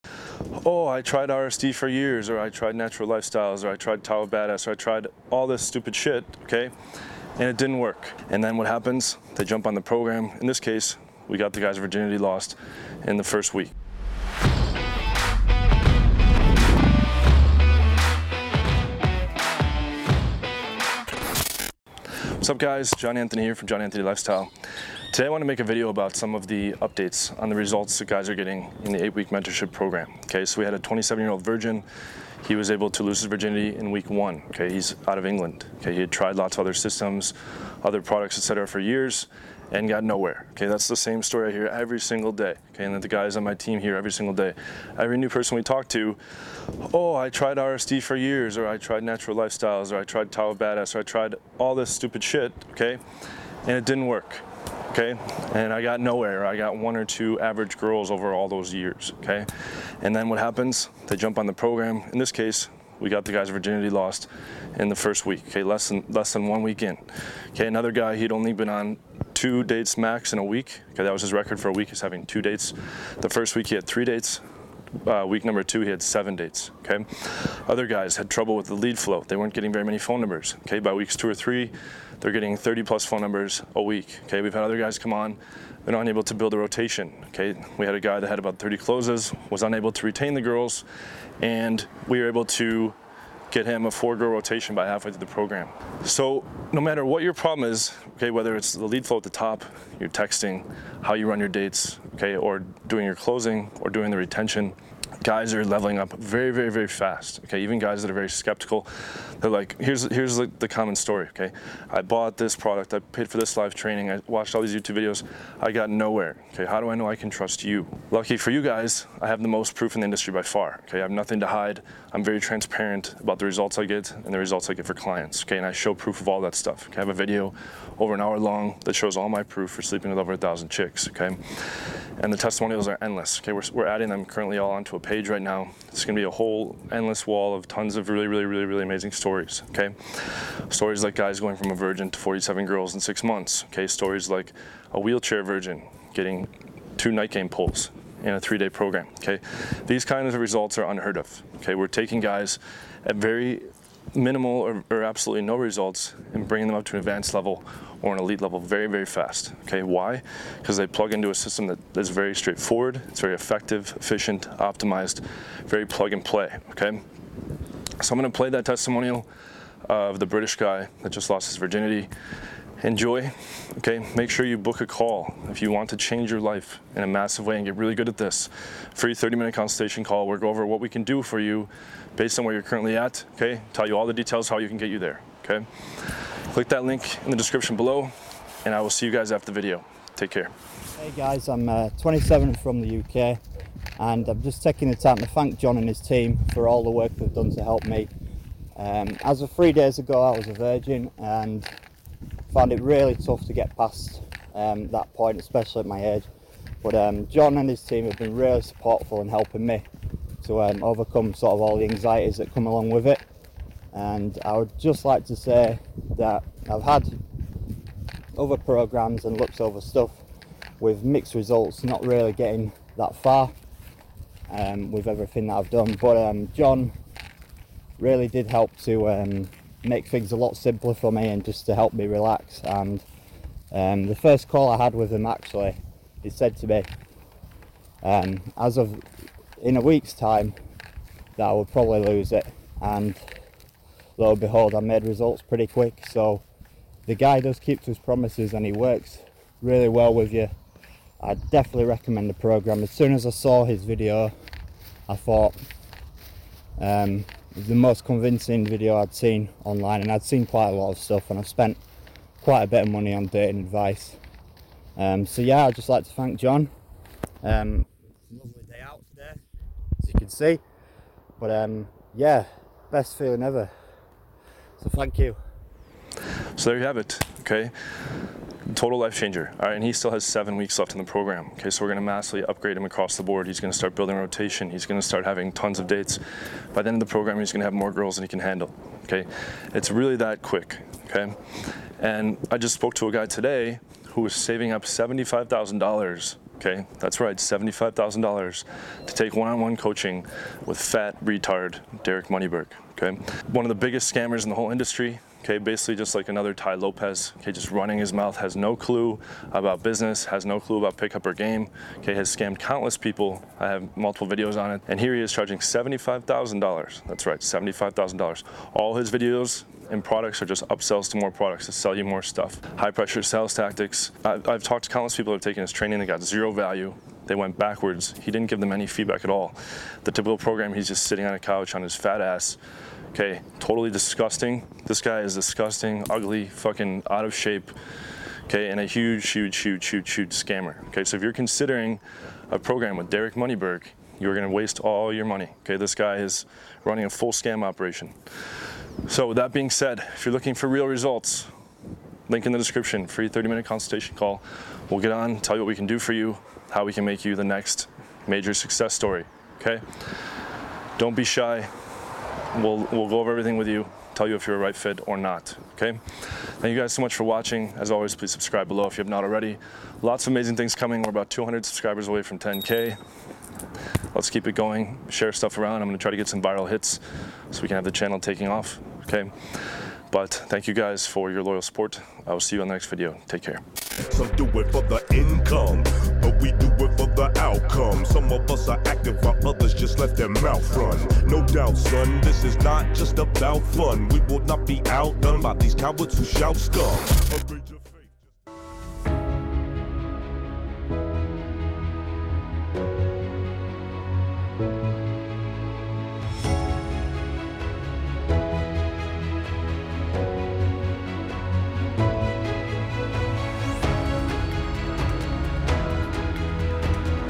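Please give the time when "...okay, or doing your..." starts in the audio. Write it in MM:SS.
01:42.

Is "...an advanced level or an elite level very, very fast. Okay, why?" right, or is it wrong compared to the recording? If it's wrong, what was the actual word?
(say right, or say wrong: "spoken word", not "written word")
right.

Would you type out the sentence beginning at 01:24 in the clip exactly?
Okay, we've had other guys come on; they're not able to build a rotation.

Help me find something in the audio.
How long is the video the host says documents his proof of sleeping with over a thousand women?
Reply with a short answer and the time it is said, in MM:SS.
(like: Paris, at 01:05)
Over an hour, at 02:07.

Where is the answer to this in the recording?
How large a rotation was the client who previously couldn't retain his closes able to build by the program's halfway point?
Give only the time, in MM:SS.
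01:33.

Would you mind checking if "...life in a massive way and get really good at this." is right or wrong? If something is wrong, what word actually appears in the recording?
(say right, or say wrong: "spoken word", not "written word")
right.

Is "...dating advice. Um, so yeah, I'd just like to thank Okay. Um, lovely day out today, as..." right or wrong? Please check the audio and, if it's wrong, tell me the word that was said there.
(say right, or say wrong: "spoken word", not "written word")
wrong: "John", not "Okay".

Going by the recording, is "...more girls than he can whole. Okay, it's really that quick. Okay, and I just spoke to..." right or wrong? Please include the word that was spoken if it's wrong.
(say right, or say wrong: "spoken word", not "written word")
wrong: "handle", not "whole".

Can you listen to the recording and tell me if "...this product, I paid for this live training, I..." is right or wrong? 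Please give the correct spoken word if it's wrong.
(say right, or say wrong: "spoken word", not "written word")
right.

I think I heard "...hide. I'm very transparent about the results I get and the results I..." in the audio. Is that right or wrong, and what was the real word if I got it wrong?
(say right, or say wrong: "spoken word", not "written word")
right.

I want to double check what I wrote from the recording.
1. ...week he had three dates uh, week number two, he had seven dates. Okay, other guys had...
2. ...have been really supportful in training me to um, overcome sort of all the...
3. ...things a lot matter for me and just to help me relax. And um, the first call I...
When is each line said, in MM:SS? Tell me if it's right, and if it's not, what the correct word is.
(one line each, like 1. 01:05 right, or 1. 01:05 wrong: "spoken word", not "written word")
1. 01:13 right
2. 03:28 wrong: "helping", not "training"
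3. 03:50 wrong: "simpler", not "matter".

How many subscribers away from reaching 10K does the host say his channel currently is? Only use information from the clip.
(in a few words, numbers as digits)
200.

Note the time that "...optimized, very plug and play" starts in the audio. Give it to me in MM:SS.
02:44.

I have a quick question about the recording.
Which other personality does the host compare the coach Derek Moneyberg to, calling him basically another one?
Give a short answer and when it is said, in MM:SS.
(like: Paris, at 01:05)
Tai Lopez, at 05:06.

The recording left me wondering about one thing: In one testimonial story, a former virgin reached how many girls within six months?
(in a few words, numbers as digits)
47.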